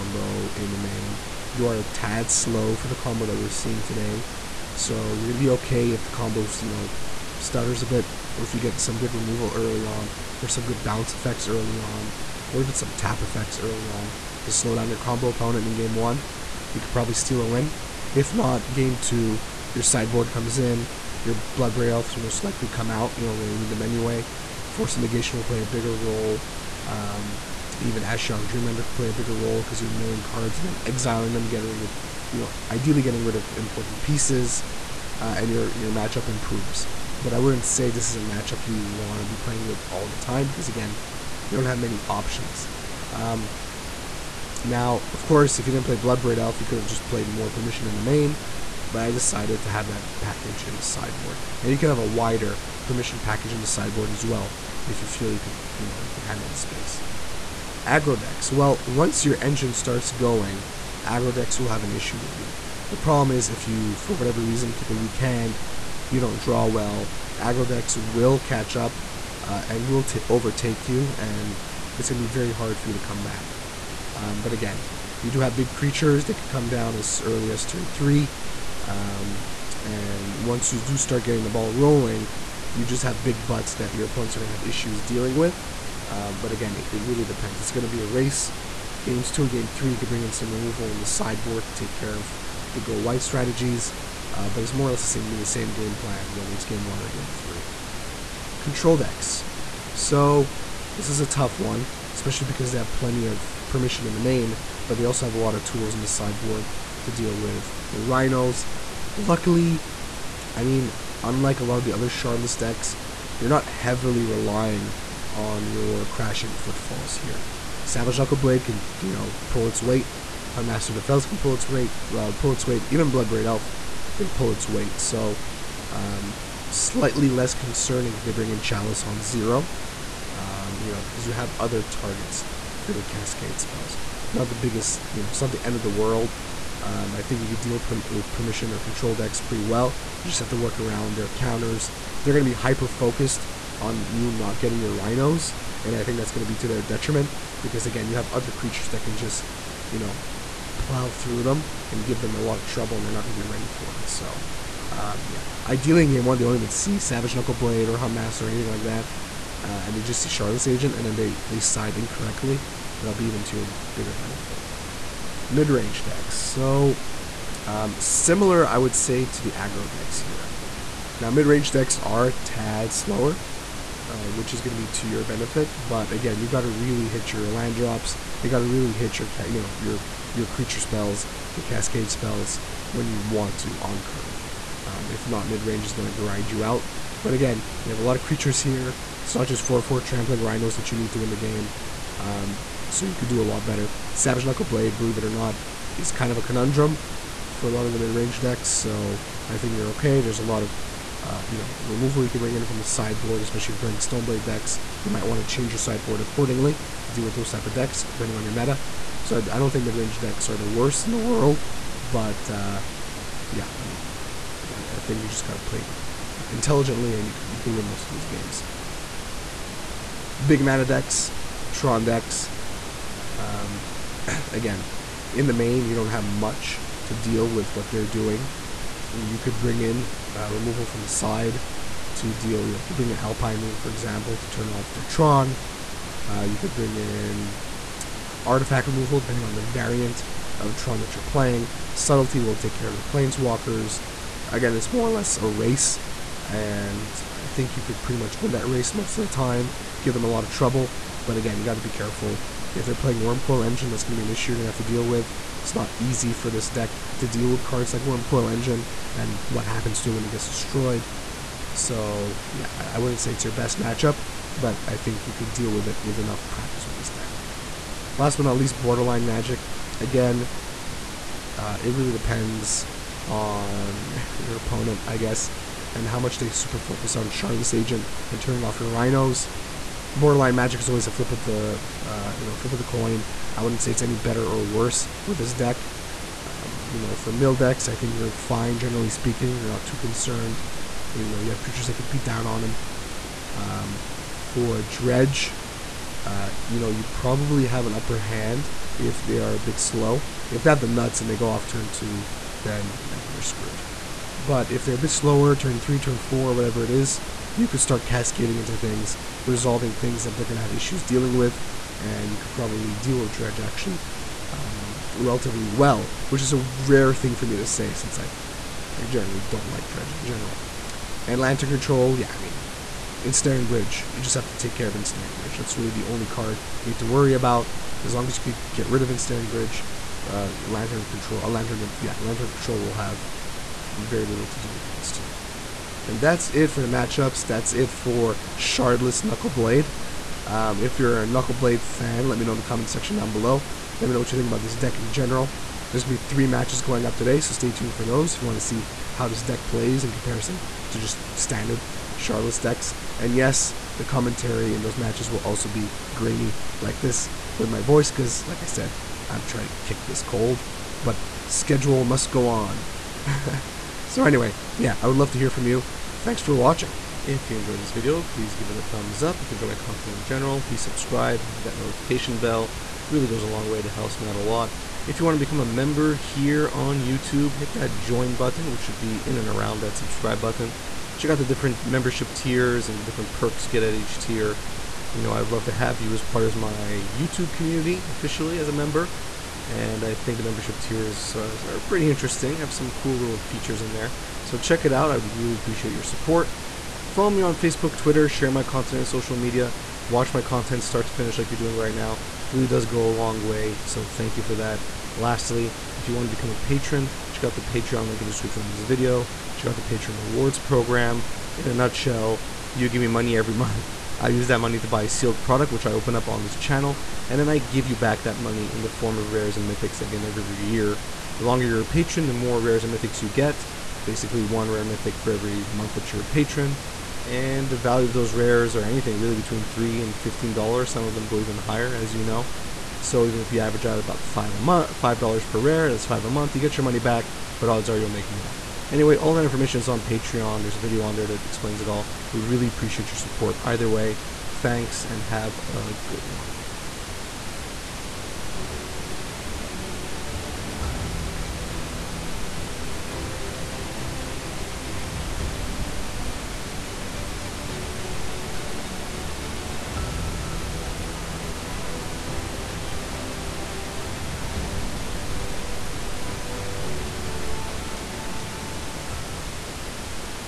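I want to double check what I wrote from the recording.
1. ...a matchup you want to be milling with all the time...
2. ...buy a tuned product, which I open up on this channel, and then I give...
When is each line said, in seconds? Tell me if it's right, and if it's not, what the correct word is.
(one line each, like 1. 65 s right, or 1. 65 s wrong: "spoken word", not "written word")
1. 38 s wrong: "playing", not "milling"
2. 414 s wrong: "sealed", not "tuned".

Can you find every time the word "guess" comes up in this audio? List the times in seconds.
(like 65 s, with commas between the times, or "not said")
275 s.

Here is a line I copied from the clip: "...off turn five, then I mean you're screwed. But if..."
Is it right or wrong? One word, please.
wrong.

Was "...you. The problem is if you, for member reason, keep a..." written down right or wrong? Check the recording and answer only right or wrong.
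wrong.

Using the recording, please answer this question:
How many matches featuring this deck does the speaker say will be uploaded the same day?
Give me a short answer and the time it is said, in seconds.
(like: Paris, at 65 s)
3, at 346 s.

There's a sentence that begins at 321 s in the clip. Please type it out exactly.
And Lantern Control, yeah, I mean, Ensnaring Bridge, you just have to take care of Ensnaring Bridge.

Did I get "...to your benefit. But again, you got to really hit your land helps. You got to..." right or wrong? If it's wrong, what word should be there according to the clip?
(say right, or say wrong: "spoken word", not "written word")
wrong: "drops", not "helps".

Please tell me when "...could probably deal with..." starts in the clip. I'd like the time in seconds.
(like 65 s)
312 s.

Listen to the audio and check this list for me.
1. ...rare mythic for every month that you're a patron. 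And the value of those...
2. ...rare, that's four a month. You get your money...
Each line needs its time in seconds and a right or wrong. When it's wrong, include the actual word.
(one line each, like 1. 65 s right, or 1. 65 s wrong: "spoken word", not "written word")
1. 424 s right
2. 435 s wrong: "five", not "four".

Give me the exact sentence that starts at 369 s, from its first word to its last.
If you enjoy my content in general, please subscribe and hit that notification bell.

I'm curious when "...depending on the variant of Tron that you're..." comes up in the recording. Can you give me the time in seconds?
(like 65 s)
239 s.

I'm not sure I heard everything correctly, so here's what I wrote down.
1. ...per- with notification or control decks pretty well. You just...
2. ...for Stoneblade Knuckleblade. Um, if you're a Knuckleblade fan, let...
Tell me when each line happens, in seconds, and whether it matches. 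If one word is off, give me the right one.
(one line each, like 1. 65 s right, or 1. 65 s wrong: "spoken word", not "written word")
1. 137 s wrong: "permission", not "notification"
2. 337 s wrong: "Shardless", not "Stoneblade".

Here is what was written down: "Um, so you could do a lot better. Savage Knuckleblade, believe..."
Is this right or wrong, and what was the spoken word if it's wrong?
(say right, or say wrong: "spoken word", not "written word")
right.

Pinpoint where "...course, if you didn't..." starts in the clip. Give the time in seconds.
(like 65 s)
45 s.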